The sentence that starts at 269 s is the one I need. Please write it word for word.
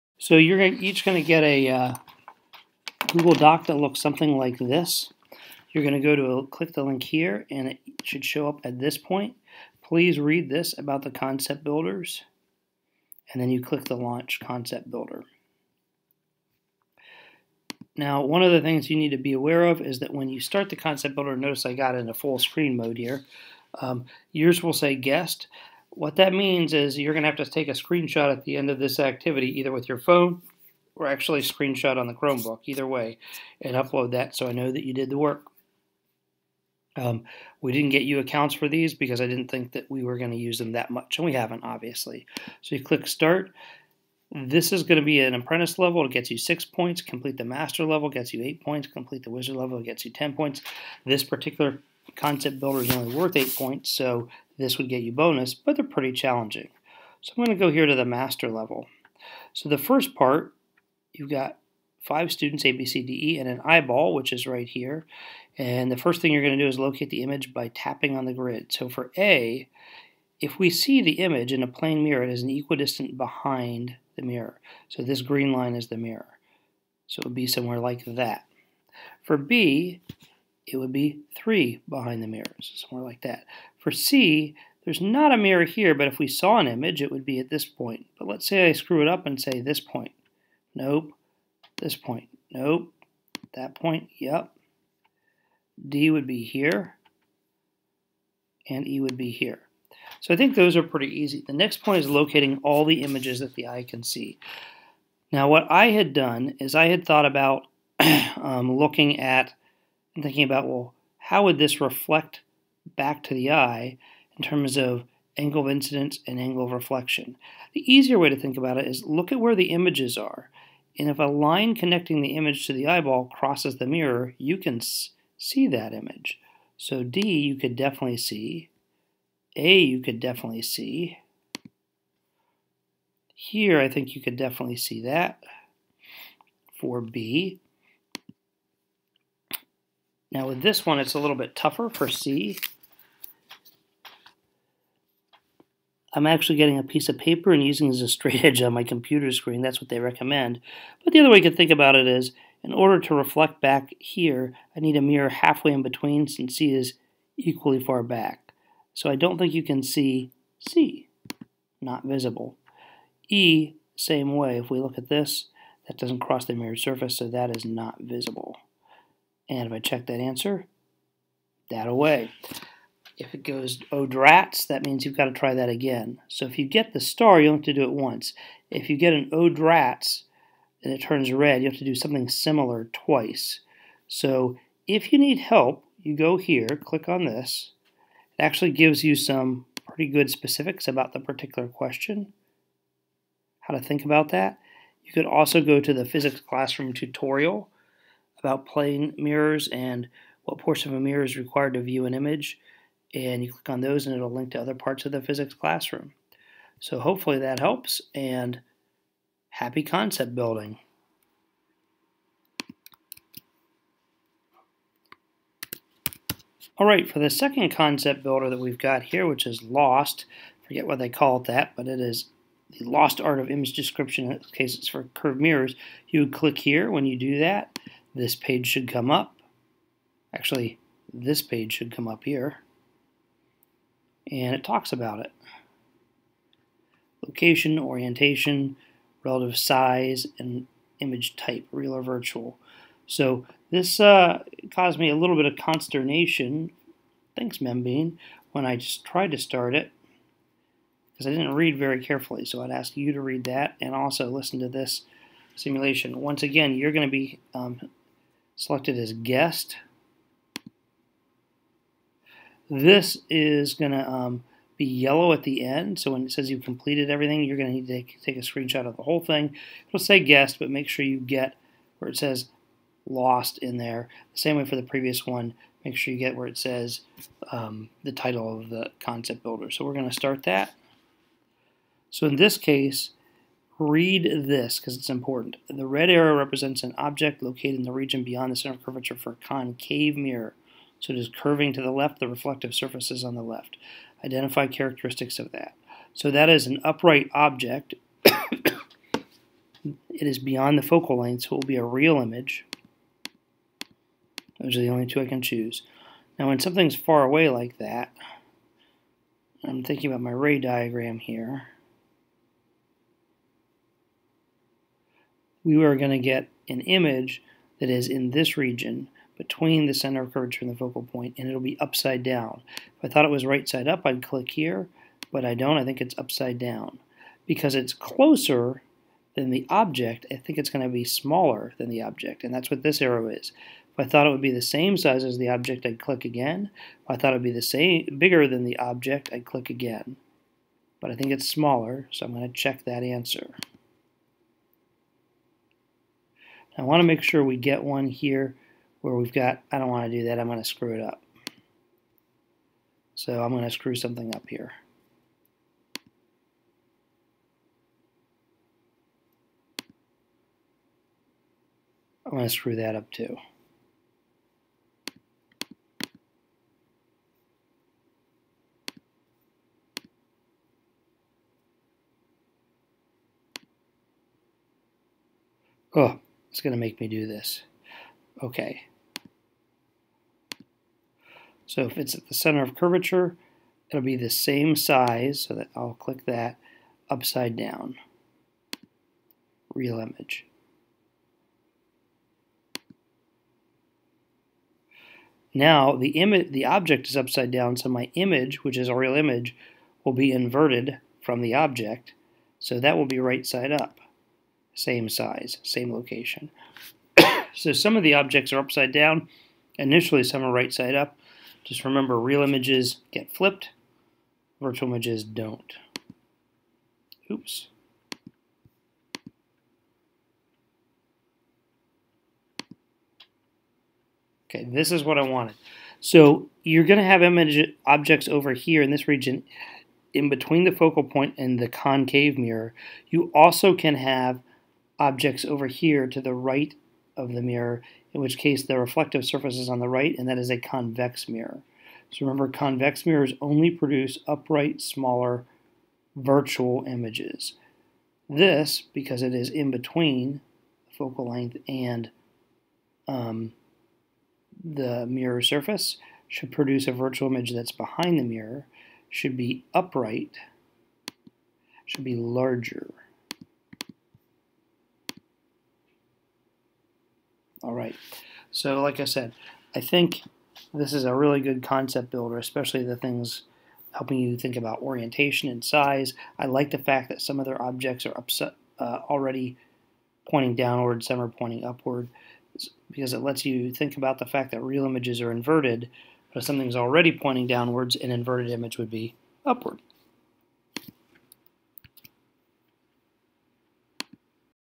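It'll say guest, but make sure you get where it says lost in there.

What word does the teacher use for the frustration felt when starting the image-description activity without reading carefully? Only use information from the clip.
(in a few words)
Consternation.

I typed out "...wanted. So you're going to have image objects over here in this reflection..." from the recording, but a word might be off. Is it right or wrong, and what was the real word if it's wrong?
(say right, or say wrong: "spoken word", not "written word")
wrong: "region", not "reflection".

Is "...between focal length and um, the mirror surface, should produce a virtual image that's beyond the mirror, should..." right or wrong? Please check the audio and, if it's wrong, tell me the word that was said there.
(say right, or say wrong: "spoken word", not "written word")
wrong: "behind", not "beyond".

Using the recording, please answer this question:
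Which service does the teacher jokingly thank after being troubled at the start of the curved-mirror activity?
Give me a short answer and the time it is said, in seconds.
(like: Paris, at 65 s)
Membean, at 247 s.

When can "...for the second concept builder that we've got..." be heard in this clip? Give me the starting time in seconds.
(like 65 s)
217 s.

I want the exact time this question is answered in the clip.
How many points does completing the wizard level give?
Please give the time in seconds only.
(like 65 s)
50 s.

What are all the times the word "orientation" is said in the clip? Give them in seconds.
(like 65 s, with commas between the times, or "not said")
237 s, 474 s.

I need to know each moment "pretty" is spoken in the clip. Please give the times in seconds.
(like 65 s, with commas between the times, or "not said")
55 s, 100 s, 189 s.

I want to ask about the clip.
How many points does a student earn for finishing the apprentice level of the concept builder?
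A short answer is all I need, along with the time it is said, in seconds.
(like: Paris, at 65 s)
6, at 46 s.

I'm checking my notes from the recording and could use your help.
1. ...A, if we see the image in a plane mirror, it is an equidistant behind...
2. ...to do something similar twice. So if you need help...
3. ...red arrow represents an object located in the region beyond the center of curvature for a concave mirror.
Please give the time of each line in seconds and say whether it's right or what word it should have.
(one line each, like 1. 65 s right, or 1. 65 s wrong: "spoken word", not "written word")
1. 69 s right
2. 181 s right
3. 285 s right.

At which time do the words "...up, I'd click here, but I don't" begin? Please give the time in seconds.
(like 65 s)
323 s.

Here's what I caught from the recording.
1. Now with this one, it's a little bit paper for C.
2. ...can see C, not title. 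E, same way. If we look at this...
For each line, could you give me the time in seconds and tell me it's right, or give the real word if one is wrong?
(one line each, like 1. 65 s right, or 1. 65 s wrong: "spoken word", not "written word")
1. 140 s wrong: "tougher", not "paper"
2. 159 s wrong: "visible", not "title".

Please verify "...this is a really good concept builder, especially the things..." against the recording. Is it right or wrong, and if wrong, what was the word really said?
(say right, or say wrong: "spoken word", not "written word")
right.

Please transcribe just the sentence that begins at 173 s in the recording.
If it goes odrats, oh, that means you've got to try that again.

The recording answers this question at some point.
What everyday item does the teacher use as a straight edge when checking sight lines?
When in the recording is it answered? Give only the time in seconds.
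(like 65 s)
146 s.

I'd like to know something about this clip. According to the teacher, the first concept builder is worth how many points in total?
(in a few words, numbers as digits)
8.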